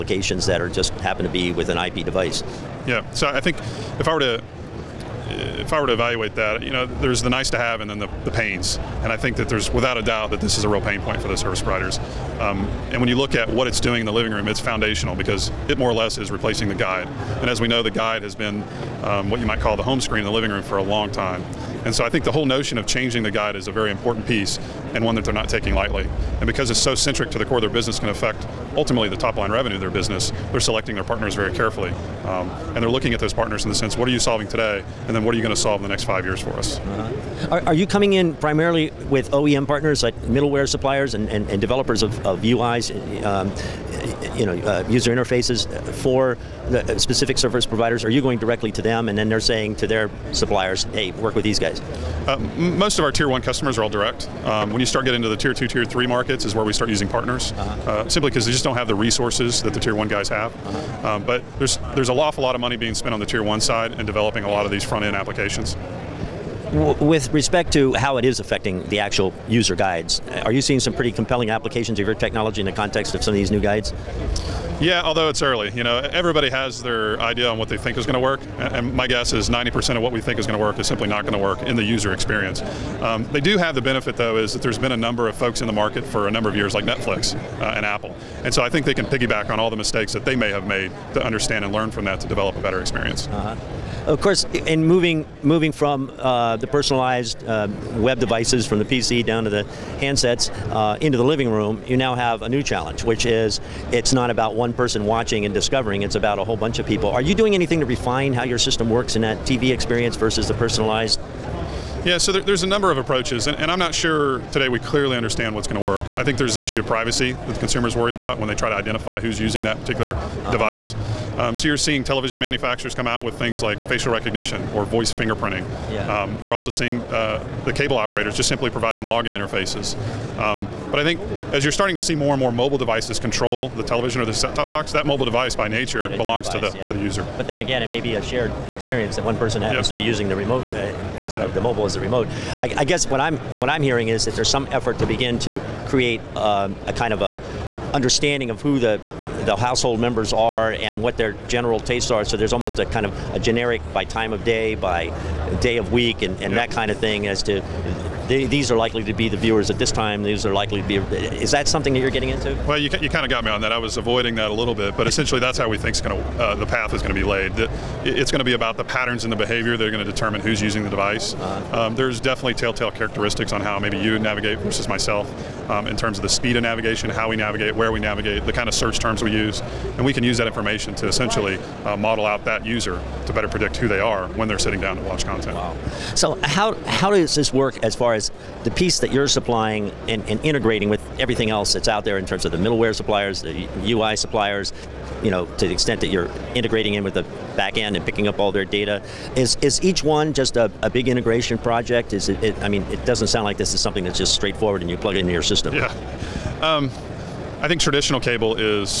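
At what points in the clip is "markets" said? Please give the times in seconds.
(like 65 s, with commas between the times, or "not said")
56 s, 85 s.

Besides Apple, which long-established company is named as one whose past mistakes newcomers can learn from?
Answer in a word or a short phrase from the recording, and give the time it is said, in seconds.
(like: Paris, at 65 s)
Netflix, at 86 s.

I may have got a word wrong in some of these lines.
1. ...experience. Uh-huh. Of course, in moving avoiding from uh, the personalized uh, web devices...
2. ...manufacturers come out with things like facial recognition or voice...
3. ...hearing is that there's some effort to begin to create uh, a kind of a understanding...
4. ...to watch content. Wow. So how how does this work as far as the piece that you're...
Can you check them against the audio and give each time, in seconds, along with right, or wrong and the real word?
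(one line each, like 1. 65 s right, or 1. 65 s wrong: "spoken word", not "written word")
1. 92 s wrong: "moving", not "avoiding"
2. 122 s right
3. 143 s right
4. 184 s right.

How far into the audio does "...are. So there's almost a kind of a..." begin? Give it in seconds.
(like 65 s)
152 s.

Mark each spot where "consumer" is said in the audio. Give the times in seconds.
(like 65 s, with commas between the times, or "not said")
117 s.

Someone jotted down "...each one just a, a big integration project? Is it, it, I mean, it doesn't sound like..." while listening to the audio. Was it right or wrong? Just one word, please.
right.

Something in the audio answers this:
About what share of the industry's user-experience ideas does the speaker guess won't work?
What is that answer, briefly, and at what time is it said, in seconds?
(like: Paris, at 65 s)
90%, at 79 s.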